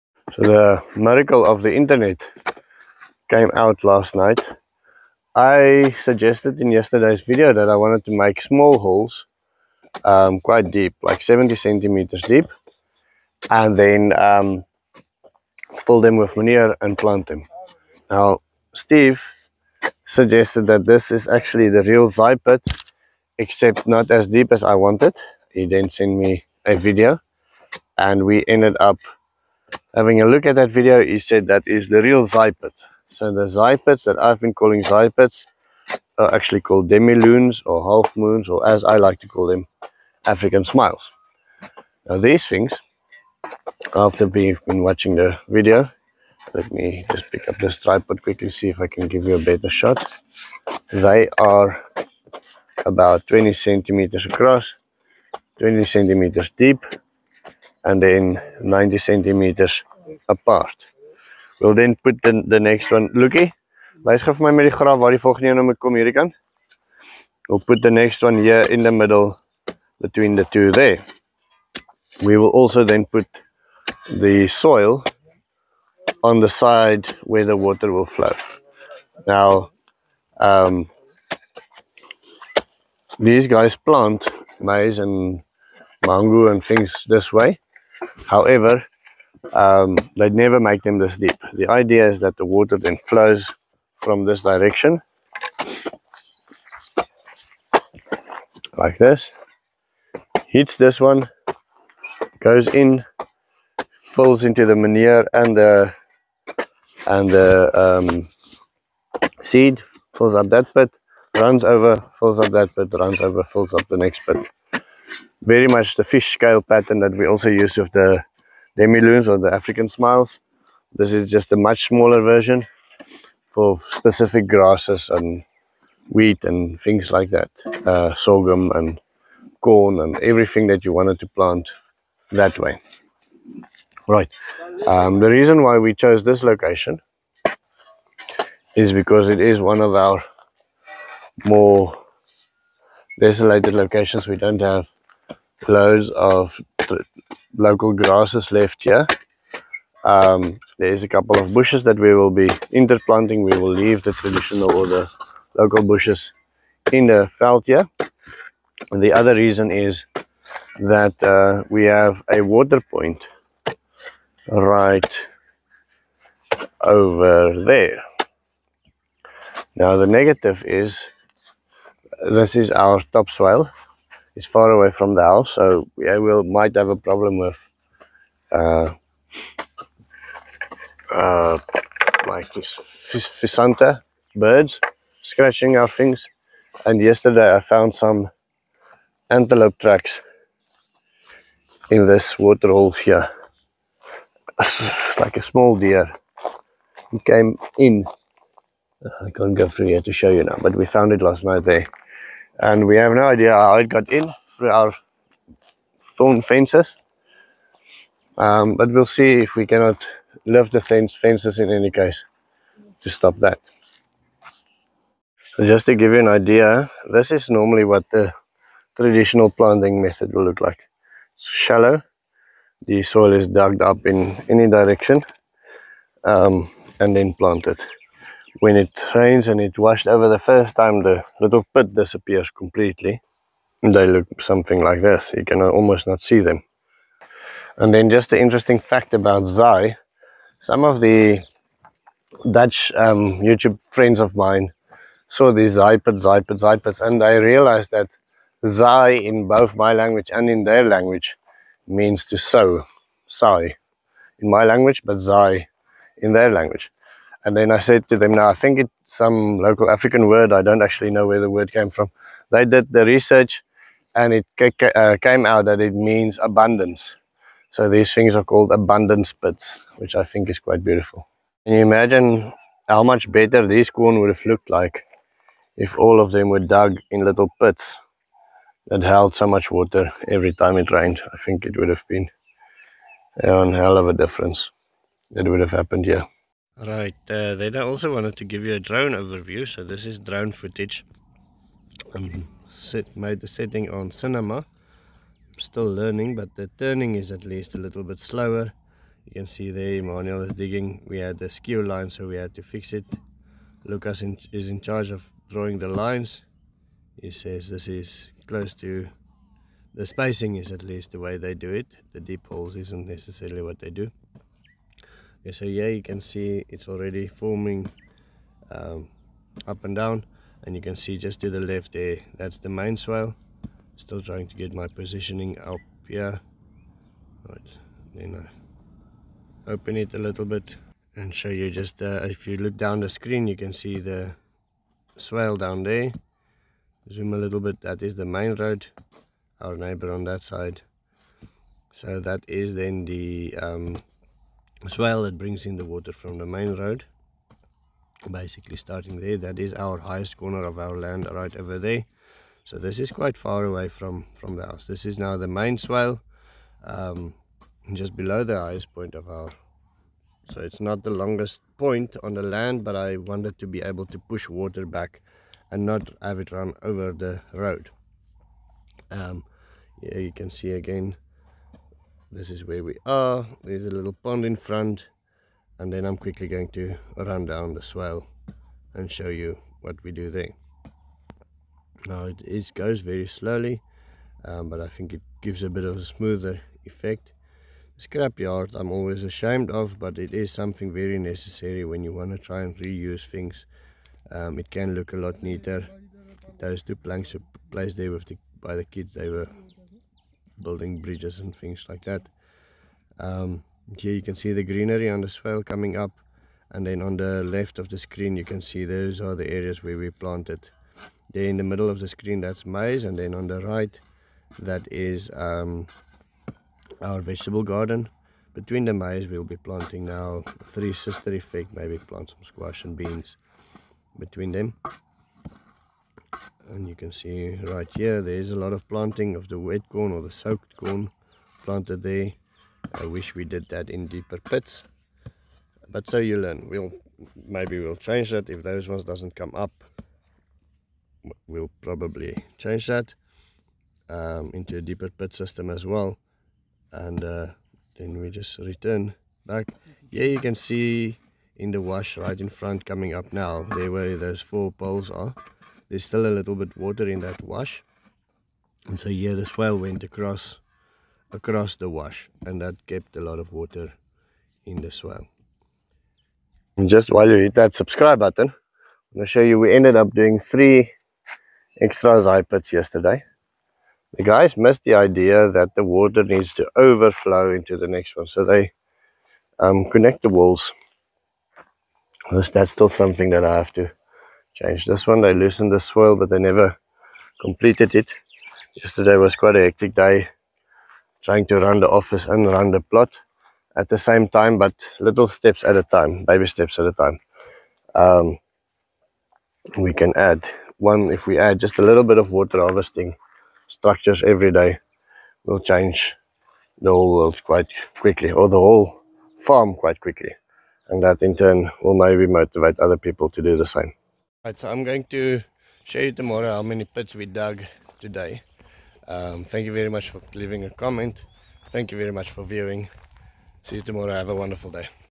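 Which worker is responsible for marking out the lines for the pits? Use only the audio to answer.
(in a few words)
Lucas.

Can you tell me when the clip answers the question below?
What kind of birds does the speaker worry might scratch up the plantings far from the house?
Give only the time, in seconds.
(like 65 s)
183 s.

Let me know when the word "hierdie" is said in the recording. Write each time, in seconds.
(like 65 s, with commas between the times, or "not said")
65 s.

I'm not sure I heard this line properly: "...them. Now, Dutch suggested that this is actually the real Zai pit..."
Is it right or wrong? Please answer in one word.
wrong.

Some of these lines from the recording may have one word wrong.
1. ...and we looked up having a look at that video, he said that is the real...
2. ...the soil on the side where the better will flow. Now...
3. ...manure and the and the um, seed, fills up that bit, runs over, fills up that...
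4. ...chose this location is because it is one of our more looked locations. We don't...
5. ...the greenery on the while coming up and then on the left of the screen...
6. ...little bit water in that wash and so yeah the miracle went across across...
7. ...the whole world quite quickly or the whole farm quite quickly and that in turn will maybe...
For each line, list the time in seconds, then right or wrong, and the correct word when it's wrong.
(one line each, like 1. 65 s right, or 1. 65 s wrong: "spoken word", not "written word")
1. 27 s wrong: "ended", not "looked"
2. 74 s wrong: "water", not "better"
3. 104 s right
4. 135 s wrong: "desolated", not "looked"
5. 404 s wrong: "swale", not "while"
6. 456 s wrong: "swale", not "miracle"
7. 506 s right.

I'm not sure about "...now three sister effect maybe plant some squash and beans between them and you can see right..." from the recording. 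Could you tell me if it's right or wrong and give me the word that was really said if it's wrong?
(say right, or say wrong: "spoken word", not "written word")
right.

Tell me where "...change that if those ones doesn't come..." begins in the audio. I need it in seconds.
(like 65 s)
437 s.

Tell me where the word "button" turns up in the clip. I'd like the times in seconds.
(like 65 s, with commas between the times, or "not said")
468 s.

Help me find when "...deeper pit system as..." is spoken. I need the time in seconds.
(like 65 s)
444 s.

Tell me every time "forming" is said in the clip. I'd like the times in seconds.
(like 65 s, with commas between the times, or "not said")
317 s.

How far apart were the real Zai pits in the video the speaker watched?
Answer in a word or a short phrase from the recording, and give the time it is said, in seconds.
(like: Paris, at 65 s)
90 centimeters, at 58 s.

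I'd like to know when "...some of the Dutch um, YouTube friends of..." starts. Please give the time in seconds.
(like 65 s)
240 s.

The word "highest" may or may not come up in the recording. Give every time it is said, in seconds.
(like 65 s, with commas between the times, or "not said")
349 s, 358 s.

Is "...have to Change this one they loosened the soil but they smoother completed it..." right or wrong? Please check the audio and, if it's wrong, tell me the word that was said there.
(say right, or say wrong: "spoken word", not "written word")
wrong: "never", not "smoother".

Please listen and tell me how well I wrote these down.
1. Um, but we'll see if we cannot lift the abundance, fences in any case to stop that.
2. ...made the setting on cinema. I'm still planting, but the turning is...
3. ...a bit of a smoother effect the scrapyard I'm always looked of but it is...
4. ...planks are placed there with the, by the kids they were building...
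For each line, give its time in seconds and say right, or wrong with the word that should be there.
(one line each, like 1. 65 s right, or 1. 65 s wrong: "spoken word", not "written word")
1. 208 s wrong: "fence", not "abundance"
2. 293 s wrong: "learning", not "planting"
3. 385 s wrong: "ashamed", not "looked"
4. 396 s right.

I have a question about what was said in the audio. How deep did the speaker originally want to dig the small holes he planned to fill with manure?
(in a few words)
70 centimeters.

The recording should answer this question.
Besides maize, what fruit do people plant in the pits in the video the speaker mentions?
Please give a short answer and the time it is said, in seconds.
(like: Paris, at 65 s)
mango, at 86 s.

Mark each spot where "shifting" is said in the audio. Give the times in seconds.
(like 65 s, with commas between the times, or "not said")
not said.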